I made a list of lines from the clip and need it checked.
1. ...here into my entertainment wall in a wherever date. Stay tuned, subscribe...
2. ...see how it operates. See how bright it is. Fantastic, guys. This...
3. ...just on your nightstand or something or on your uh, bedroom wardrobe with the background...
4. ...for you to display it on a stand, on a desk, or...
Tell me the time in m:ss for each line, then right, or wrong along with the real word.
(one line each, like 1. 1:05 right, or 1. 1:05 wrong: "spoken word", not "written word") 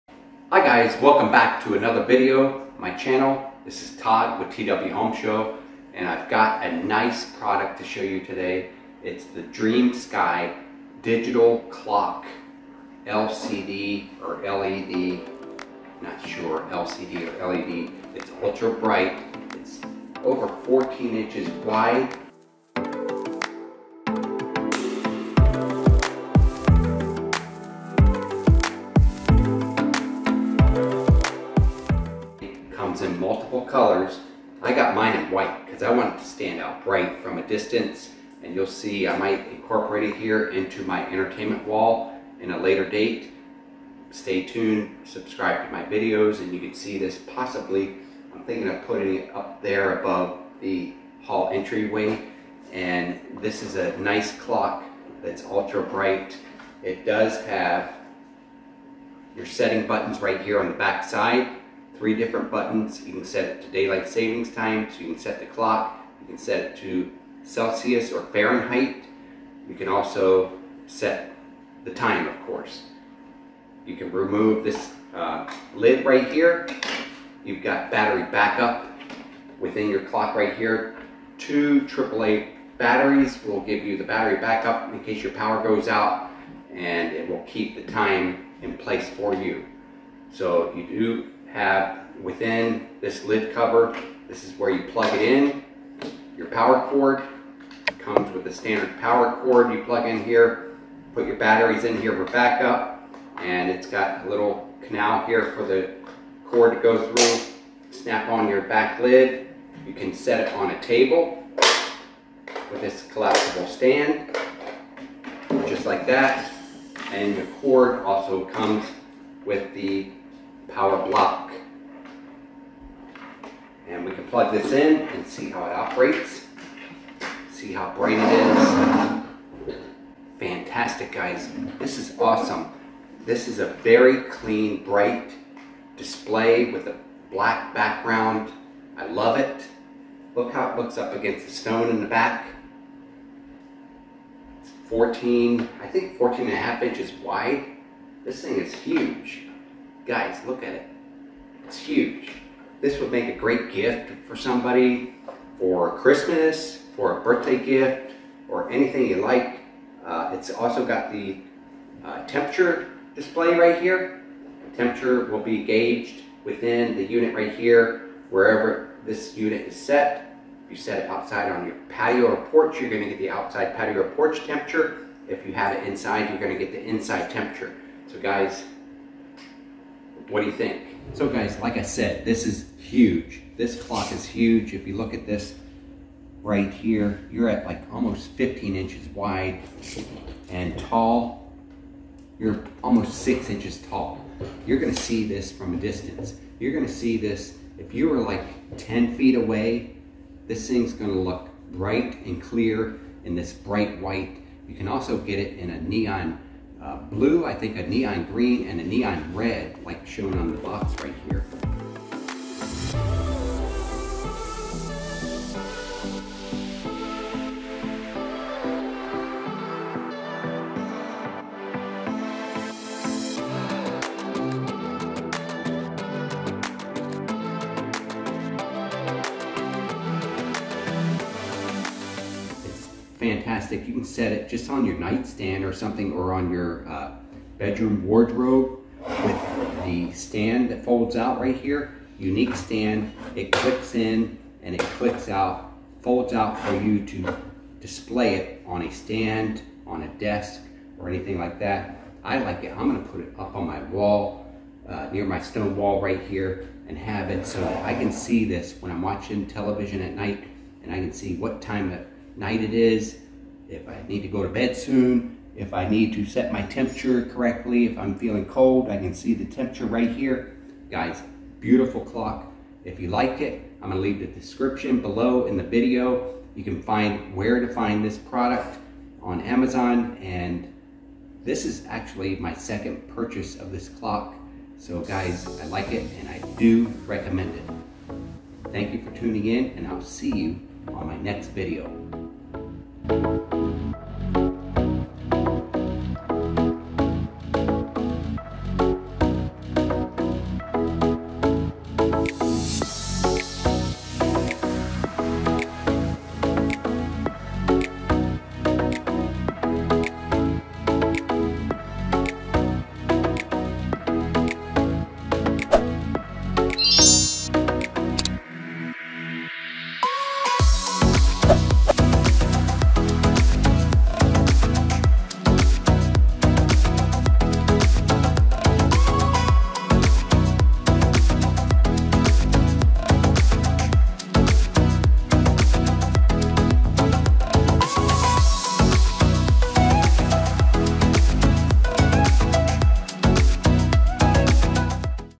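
1. 0:40 wrong: "later", not "wherever"
2. 2:05 right
3. 3:54 wrong: "stand", not "background"
4. 4:06 right.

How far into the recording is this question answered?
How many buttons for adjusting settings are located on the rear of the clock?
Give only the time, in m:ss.
1:02.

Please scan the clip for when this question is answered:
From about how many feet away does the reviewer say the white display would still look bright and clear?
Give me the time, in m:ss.
3:18.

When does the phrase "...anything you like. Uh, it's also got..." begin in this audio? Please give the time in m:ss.
2:38.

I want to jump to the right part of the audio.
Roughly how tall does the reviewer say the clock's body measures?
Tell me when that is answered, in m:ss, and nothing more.
3:12.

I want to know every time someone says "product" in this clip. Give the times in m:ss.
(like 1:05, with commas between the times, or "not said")
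0:07, 4:38.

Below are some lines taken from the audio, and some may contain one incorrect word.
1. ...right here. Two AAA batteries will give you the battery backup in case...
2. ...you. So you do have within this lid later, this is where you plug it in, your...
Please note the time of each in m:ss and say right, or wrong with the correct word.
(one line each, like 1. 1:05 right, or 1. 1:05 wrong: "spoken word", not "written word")
1. 1:20 right
2. 1:29 wrong: "cover", not "later".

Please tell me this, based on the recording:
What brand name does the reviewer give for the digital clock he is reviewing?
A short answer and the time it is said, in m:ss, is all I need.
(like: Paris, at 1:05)
DreamSky, at 0:09.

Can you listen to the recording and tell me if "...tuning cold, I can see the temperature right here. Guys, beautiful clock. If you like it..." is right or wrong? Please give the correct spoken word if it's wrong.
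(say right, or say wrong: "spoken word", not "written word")
wrong: "feeling", not "tuning".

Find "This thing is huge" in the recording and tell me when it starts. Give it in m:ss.
2:28.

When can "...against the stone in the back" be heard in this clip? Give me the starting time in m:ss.
2:21.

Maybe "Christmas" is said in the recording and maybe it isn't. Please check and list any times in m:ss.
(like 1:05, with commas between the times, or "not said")
2:35.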